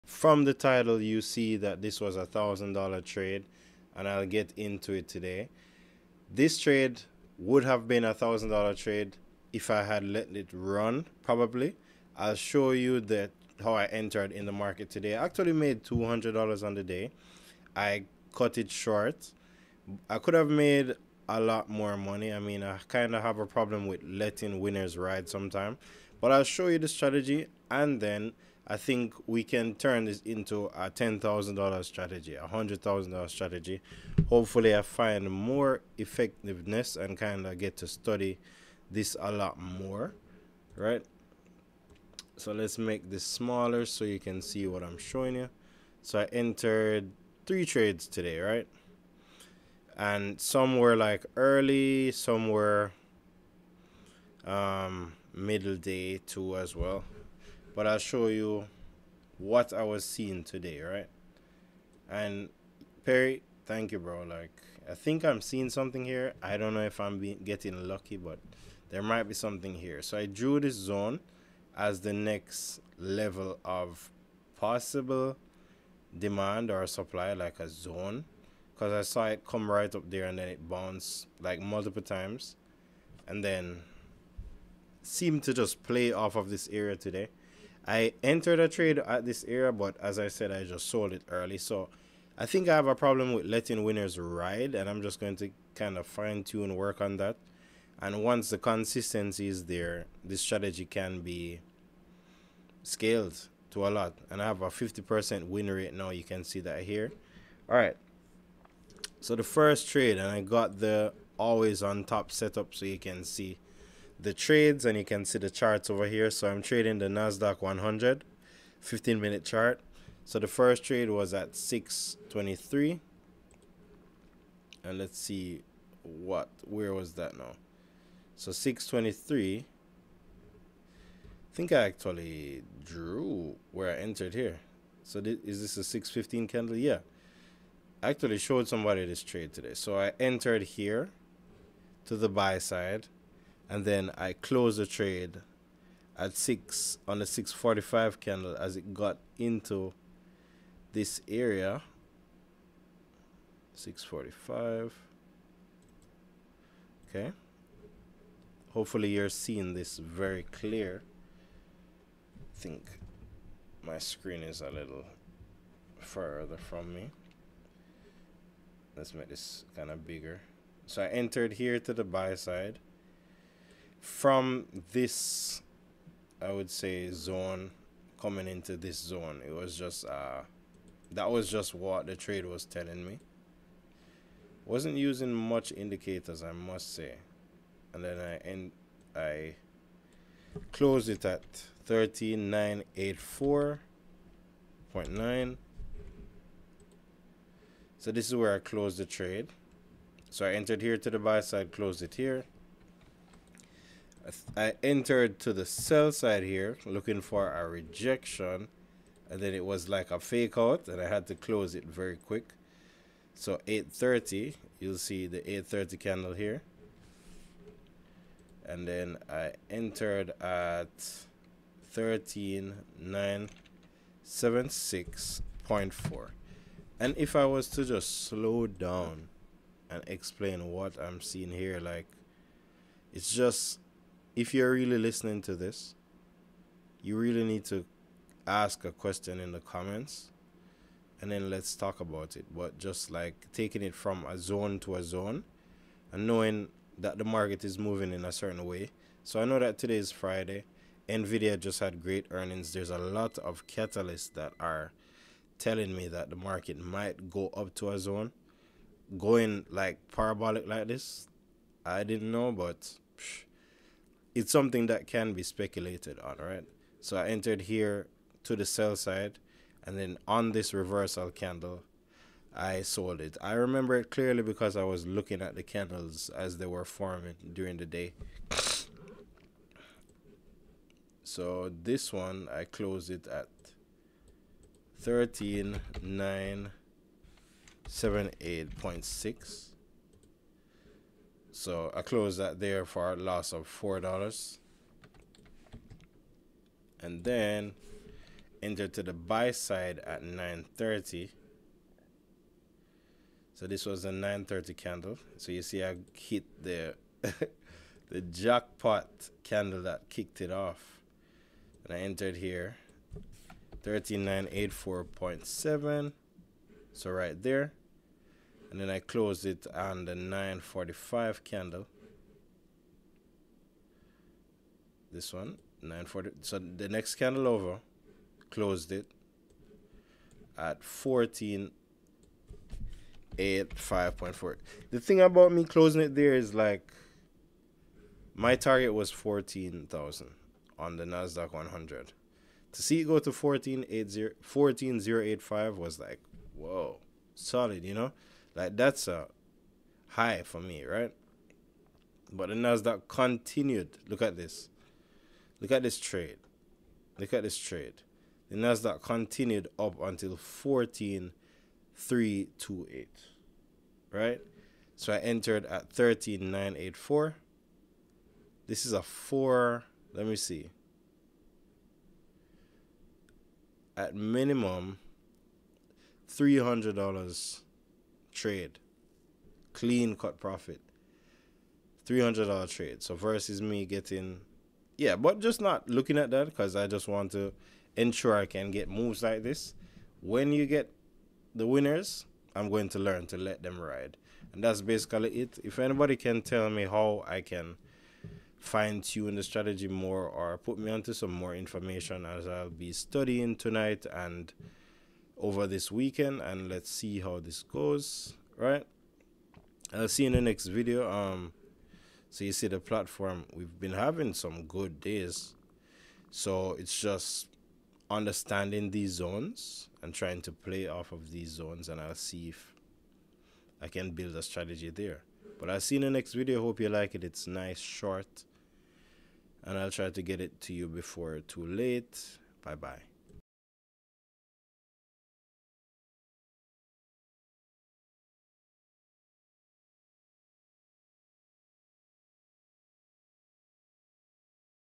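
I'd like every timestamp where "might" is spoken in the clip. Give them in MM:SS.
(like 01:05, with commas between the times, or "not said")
01:09, 04:16.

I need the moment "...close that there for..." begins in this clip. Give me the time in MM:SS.
04:52.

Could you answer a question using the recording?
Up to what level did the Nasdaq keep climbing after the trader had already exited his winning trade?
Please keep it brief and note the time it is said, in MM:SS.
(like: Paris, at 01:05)
14,328, at 06:00.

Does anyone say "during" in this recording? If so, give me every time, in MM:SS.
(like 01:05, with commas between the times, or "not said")
04:37.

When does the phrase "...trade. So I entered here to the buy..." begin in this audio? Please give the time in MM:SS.
03:19.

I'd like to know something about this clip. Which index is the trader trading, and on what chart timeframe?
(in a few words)
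NASDAQ 100 15 minute.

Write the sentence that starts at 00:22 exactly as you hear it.
I mean, I kind of have a problem with letting winners ride sometime.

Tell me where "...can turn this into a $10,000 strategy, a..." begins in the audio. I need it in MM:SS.
00:29.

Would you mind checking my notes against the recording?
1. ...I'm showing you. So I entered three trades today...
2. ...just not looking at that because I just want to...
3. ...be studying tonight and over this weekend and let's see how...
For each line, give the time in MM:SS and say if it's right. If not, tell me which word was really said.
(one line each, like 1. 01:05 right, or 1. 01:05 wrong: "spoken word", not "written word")
1. 00:44 right
2. 06:25 right
3. 06:42 right.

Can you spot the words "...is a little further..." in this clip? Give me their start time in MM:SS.
02:44.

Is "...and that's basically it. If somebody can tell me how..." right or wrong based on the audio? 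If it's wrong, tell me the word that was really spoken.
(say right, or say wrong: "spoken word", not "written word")
wrong: "anybody", not "somebody".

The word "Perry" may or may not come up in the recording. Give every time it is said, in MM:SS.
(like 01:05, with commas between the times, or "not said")
01:03.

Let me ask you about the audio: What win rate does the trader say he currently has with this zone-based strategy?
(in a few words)
50%.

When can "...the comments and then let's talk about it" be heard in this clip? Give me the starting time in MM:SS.
03:59.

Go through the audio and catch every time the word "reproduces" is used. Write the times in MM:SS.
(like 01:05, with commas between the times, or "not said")
not said.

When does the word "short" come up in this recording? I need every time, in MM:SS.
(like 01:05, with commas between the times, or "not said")
00:18, 07:07.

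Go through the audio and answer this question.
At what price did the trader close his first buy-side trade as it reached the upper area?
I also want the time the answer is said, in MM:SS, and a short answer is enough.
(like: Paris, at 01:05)
13,984.9, at 03:11.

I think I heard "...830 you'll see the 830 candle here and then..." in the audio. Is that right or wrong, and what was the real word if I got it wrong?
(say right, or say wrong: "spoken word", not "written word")
right.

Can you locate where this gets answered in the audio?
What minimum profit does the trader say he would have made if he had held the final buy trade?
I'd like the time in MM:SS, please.
06:22.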